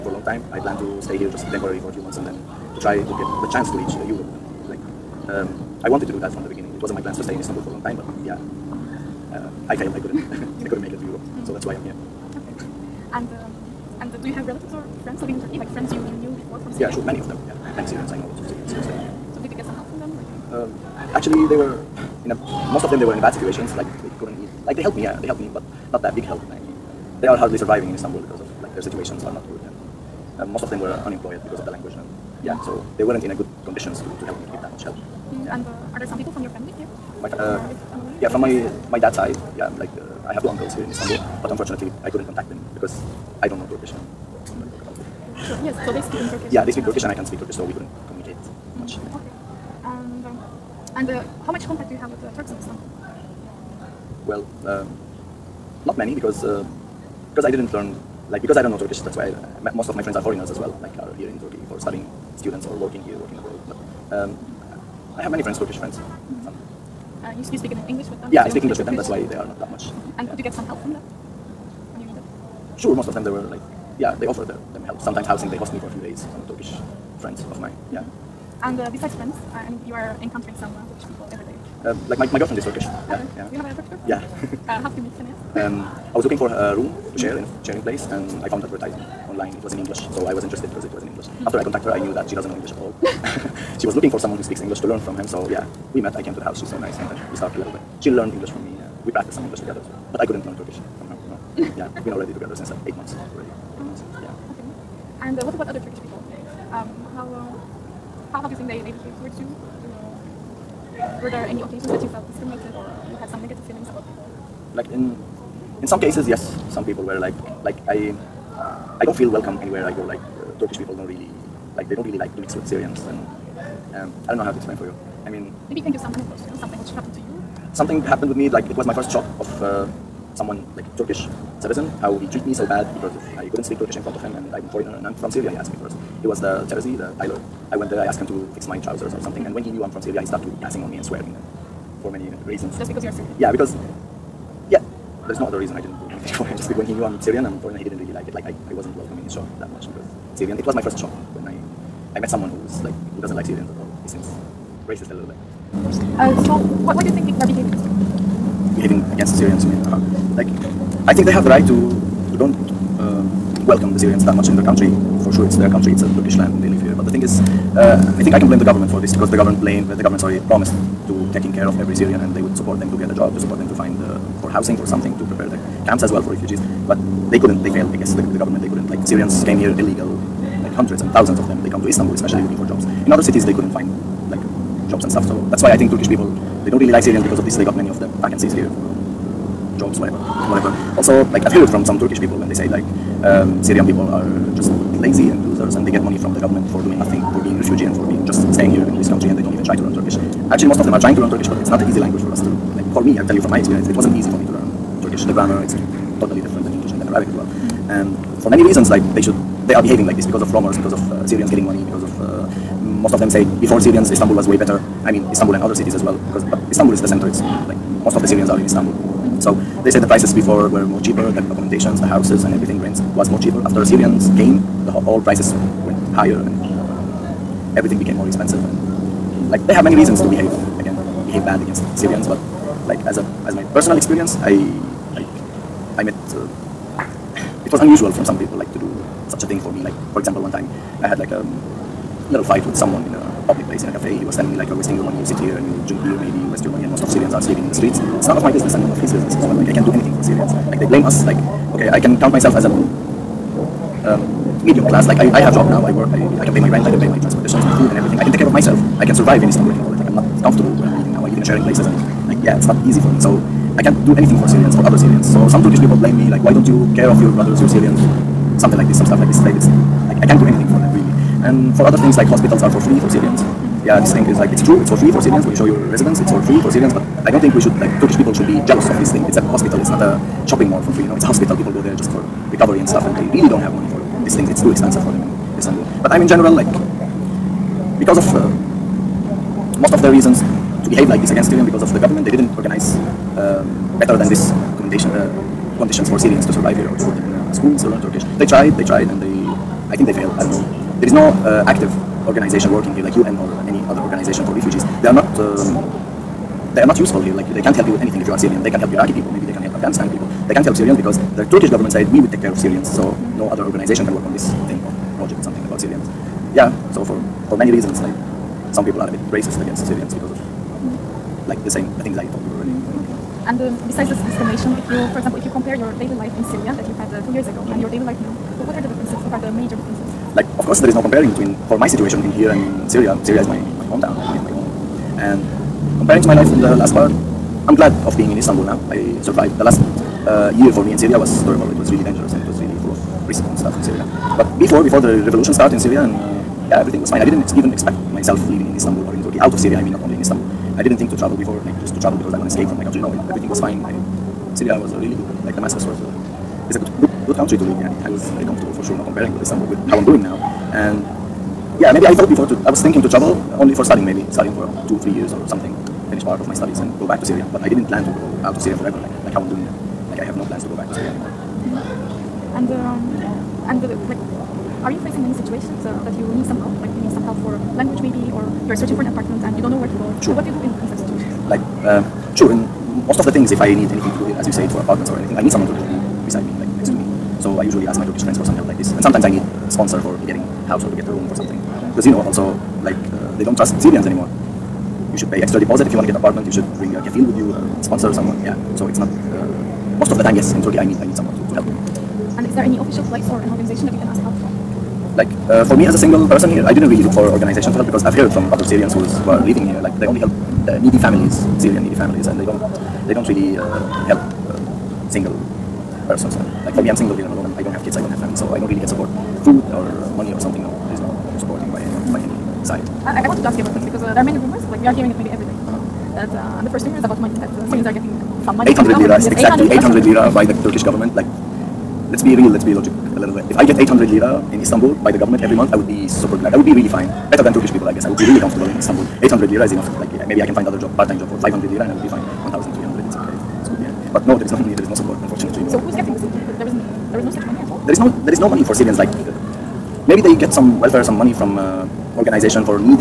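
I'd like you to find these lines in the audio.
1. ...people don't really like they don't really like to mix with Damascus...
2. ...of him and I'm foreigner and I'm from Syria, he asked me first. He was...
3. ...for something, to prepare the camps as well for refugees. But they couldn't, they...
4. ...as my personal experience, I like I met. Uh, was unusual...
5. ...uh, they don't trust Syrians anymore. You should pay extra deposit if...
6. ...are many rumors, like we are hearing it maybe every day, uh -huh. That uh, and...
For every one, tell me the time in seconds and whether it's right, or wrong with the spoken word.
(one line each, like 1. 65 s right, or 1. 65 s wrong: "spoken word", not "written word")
1. 120 s wrong: "Syrians", not "Damascus"
2. 134 s right
3. 174 s right
4. 233 s right
5. 393 s right
6. 424 s right.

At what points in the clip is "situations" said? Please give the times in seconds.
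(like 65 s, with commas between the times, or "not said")
23 s, 28 s, 331 s, 375 s, 381 s.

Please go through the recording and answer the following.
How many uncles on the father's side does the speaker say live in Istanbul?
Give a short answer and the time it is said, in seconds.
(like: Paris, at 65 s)
2, at 40 s.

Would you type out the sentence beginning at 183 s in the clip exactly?
In other cities they couldn't find like jobs and stuff.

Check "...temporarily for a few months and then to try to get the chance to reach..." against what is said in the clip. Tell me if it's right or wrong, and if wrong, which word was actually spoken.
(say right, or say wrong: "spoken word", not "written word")
right.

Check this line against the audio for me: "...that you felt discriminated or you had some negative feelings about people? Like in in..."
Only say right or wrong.
right.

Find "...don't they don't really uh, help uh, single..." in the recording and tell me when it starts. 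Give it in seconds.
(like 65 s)
412 s.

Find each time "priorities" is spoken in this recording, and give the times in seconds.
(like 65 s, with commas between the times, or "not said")
not said.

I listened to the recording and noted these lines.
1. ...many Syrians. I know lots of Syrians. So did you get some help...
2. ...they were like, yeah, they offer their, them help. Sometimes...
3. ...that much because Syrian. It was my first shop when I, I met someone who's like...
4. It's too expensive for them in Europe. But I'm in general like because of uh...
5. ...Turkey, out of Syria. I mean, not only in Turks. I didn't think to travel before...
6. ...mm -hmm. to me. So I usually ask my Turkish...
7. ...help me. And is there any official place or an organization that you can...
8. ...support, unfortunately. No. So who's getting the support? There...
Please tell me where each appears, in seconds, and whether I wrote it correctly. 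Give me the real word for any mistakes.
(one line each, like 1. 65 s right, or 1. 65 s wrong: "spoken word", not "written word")
1. 17 s right
2. 73 s right
3. 149 s right
4. 284 s wrong: "Istanbul", not "Europe"
5. 349 s wrong: "Istanbul", not "Turks"
6. 386 s right
7. 401 s right
8. 444 s right.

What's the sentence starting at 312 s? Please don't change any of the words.
So no other organization can work on this thing or project something about Syrians.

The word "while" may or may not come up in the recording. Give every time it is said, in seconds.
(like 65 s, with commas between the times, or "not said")
not said.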